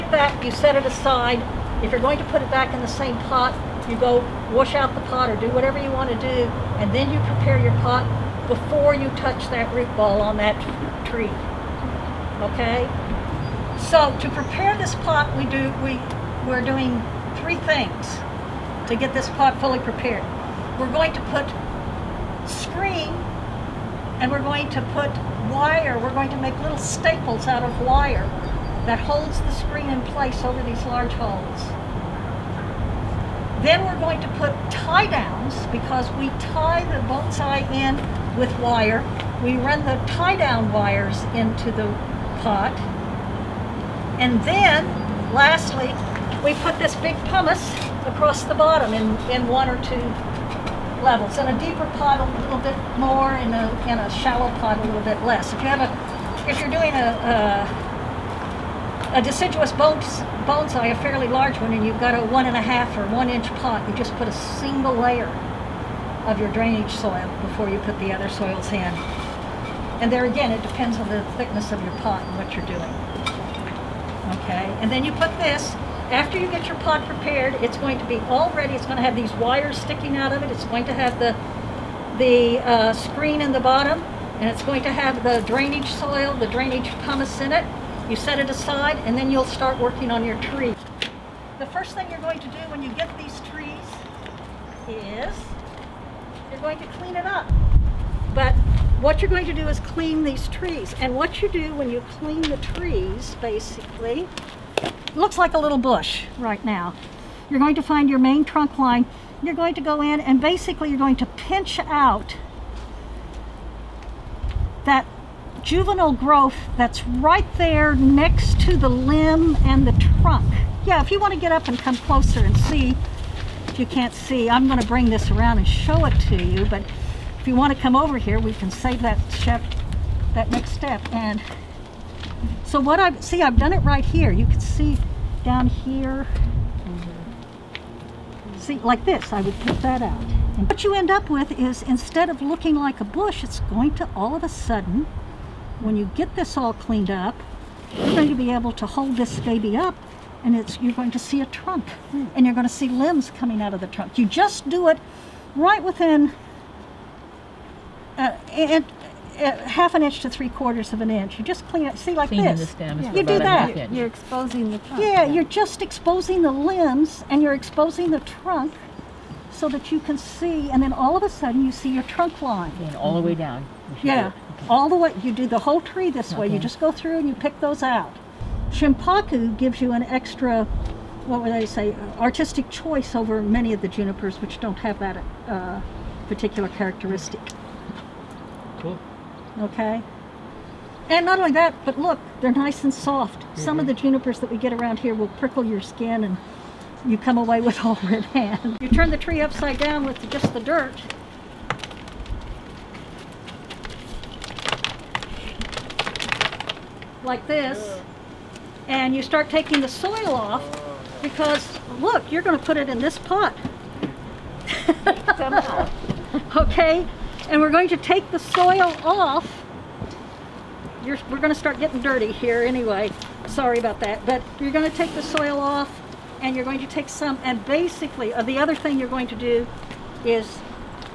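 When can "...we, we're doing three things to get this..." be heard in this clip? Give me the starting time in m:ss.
0:15.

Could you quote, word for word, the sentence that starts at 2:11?
And so what I've, see, I've done it right here.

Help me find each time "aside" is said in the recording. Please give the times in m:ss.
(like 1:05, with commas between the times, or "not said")
0:00, 1:28.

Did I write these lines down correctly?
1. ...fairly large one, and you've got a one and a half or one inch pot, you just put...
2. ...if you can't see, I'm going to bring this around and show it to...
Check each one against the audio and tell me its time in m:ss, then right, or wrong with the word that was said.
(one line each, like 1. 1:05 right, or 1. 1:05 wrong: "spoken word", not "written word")
1. 1:00 right
2. 2:03 right.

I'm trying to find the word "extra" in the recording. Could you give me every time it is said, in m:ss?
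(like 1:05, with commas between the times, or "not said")
3:00.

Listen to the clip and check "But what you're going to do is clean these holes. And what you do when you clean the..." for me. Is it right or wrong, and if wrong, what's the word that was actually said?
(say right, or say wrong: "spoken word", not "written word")
wrong: "trees", not "holes".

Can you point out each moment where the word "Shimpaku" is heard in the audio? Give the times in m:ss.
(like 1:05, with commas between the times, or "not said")
2:58.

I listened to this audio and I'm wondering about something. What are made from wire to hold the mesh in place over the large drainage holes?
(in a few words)
little staples.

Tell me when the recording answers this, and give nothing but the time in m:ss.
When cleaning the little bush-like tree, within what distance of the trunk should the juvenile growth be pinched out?
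2:39.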